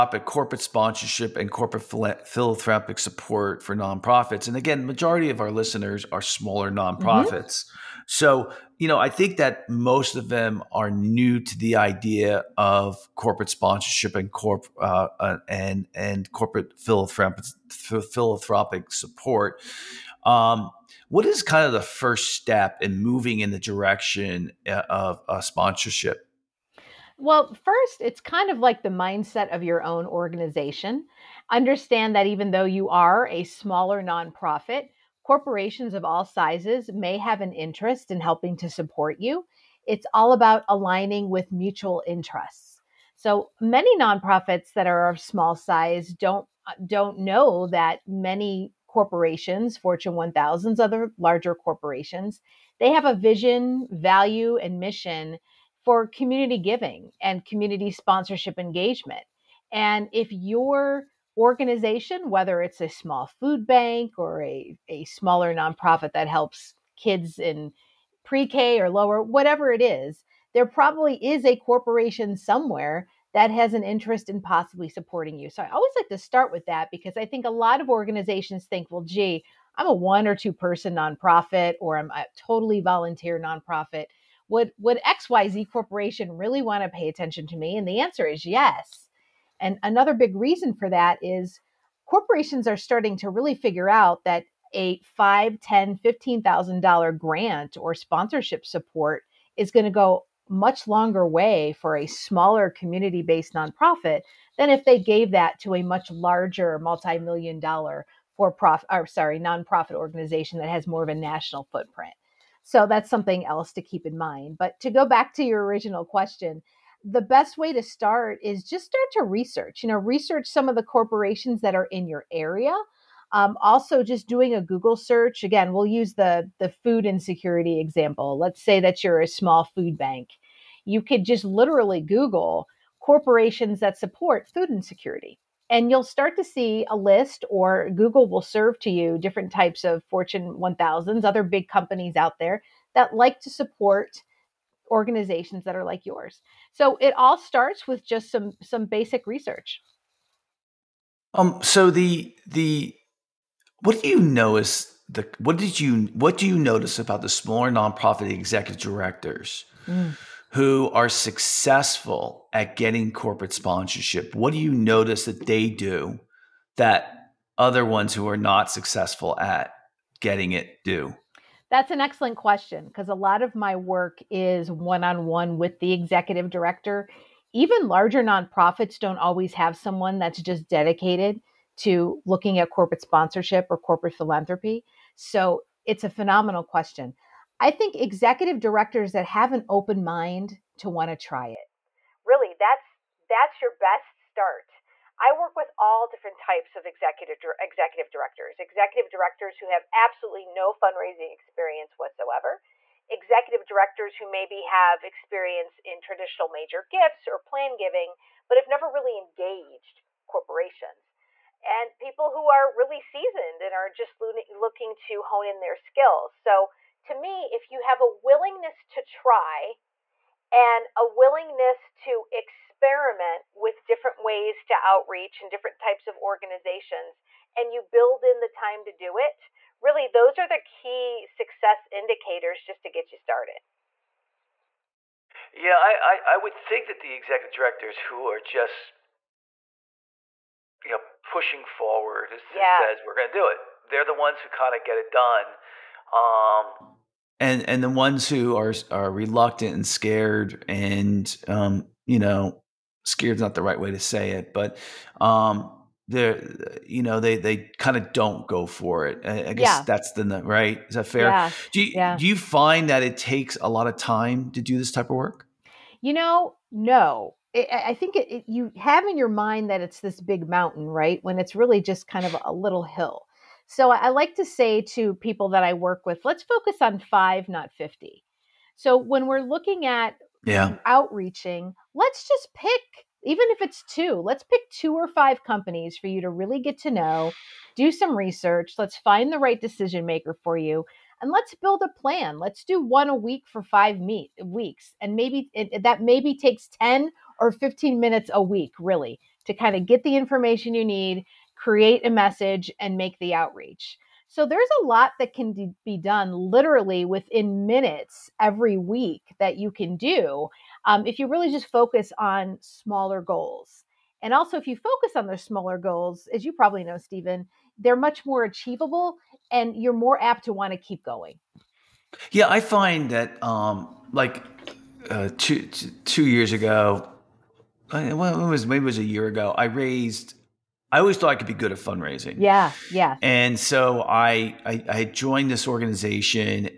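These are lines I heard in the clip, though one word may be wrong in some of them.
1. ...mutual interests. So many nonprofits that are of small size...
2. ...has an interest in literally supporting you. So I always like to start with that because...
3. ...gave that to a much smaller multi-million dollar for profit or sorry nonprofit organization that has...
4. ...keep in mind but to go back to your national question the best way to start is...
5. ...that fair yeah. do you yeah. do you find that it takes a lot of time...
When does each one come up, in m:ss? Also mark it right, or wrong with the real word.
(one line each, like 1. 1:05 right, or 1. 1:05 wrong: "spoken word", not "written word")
1. 0:41 right
2. 1:13 wrong: "possibly", not "literally"
3. 1:44 wrong: "larger", not "smaller"
4. 1:53 wrong: "original", not "national"
5. 4:20 right.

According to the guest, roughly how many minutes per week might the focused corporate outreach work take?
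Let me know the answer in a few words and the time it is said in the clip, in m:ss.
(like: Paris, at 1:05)
10 or 15 minutes, at 4:56.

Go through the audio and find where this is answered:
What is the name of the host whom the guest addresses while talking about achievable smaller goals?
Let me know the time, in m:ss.
5:16.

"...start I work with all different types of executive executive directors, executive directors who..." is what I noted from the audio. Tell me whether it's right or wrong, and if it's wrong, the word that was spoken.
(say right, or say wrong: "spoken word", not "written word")
right.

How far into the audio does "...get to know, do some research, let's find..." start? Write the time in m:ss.
4:46.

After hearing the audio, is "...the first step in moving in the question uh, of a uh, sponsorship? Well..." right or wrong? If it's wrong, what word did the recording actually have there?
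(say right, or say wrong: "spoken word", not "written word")
wrong: "direction", not "question".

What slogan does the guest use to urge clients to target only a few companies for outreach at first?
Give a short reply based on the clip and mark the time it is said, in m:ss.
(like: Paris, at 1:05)
five, not 50, at 4:36.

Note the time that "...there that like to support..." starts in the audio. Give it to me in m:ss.
2:22.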